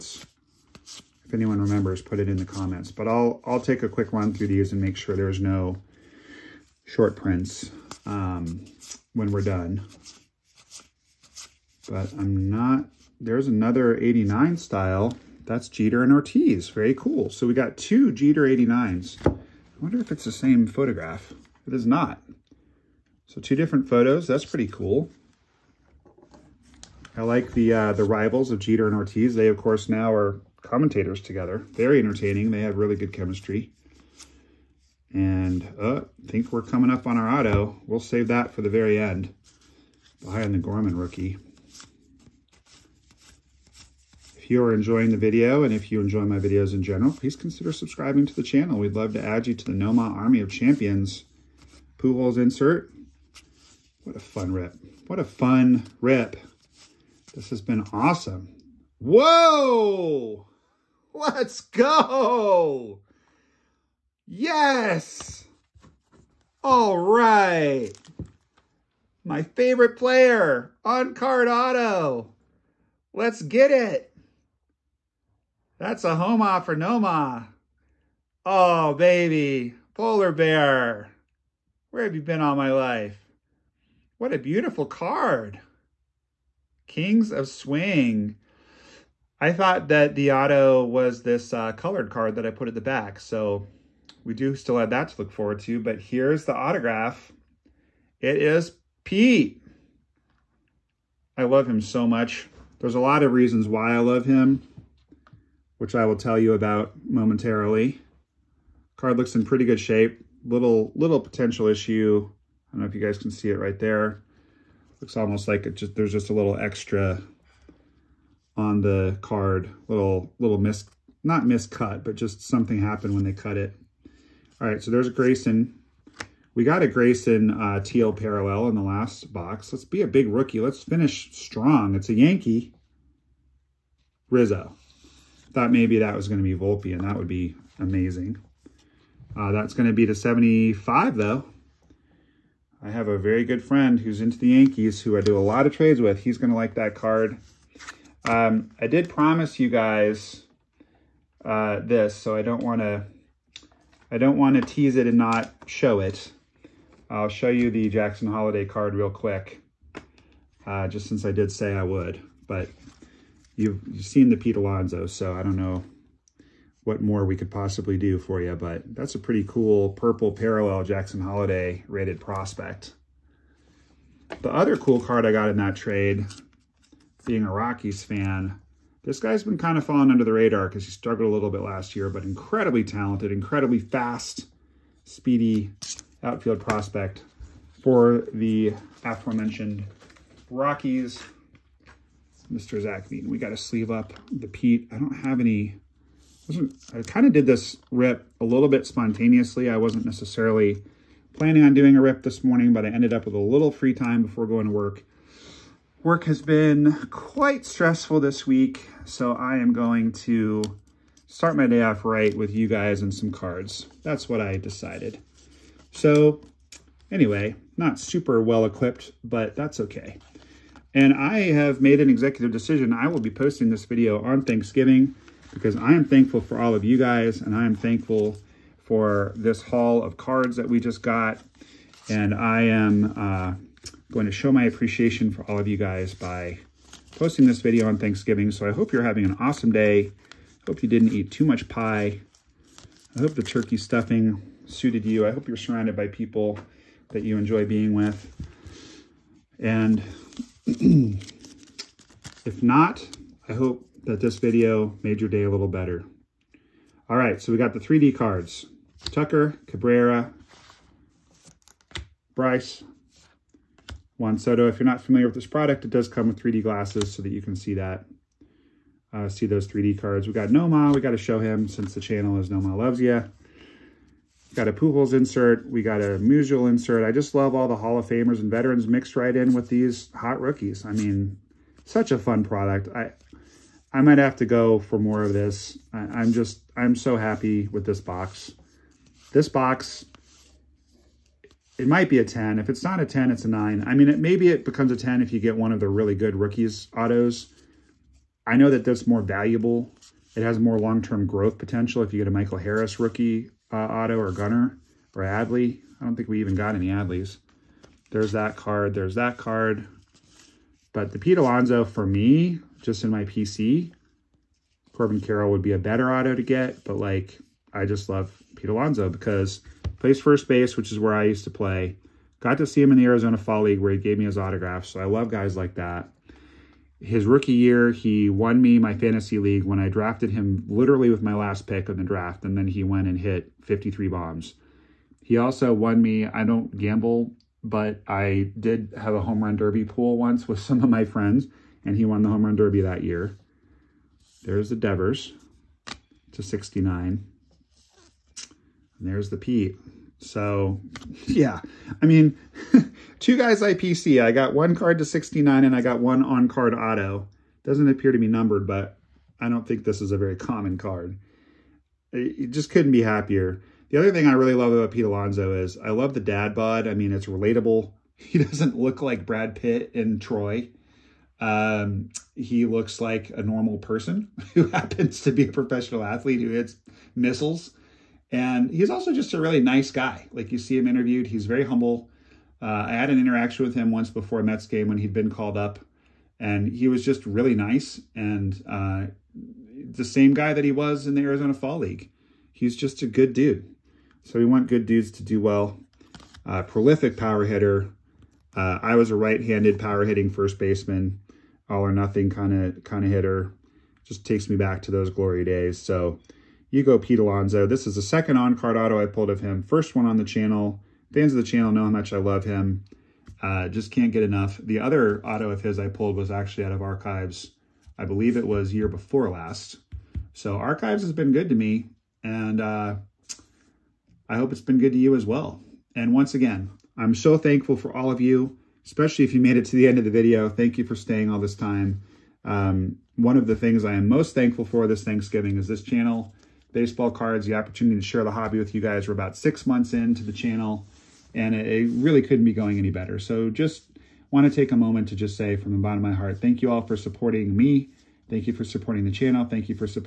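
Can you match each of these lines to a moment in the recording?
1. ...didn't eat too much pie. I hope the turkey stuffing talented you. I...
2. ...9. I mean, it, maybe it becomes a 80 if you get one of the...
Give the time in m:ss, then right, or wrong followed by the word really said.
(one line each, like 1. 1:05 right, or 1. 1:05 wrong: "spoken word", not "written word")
1. 4:00 wrong: "suited", not "talented"
2. 4:53 wrong: "10", not "80".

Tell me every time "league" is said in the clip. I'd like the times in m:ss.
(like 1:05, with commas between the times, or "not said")
5:23, 5:29, 6:31.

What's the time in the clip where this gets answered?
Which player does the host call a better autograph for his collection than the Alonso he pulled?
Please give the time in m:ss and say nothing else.
5:14.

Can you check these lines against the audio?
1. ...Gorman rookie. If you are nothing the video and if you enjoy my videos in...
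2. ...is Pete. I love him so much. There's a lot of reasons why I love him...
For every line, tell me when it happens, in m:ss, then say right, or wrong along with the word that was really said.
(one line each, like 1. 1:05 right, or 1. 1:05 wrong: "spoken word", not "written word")
1. 0:40 wrong: "enjoying", not "nothing"
2. 1:38 right.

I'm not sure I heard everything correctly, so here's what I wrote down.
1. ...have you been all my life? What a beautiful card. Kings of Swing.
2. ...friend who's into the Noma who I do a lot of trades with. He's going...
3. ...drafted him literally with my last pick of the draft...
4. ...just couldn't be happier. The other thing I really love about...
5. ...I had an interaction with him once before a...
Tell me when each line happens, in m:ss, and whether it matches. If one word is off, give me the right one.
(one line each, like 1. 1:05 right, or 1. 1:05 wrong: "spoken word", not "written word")
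1. 1:22 right
2. 2:23 wrong: "Yankees", not "Noma"
3. 5:29 right
4. 6:02 right
5. 6:22 right.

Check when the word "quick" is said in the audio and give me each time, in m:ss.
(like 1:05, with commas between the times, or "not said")
0:03, 2:39.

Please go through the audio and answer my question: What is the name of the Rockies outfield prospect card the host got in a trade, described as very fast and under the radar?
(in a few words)
Zach Beaton.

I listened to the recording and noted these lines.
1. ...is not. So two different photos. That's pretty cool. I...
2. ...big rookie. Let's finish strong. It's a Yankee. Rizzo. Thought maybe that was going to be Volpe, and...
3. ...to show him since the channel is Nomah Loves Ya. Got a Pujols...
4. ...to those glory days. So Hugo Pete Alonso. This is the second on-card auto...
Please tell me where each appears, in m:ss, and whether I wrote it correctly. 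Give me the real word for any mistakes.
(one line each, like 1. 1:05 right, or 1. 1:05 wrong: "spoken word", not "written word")
1. 0:21 right
2. 2:10 right
3. 4:31 right
4. 6:44 right.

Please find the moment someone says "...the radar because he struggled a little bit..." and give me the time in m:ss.
3:00.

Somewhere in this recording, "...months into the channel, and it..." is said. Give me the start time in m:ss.
7:19.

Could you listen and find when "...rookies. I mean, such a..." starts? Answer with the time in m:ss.
4:40.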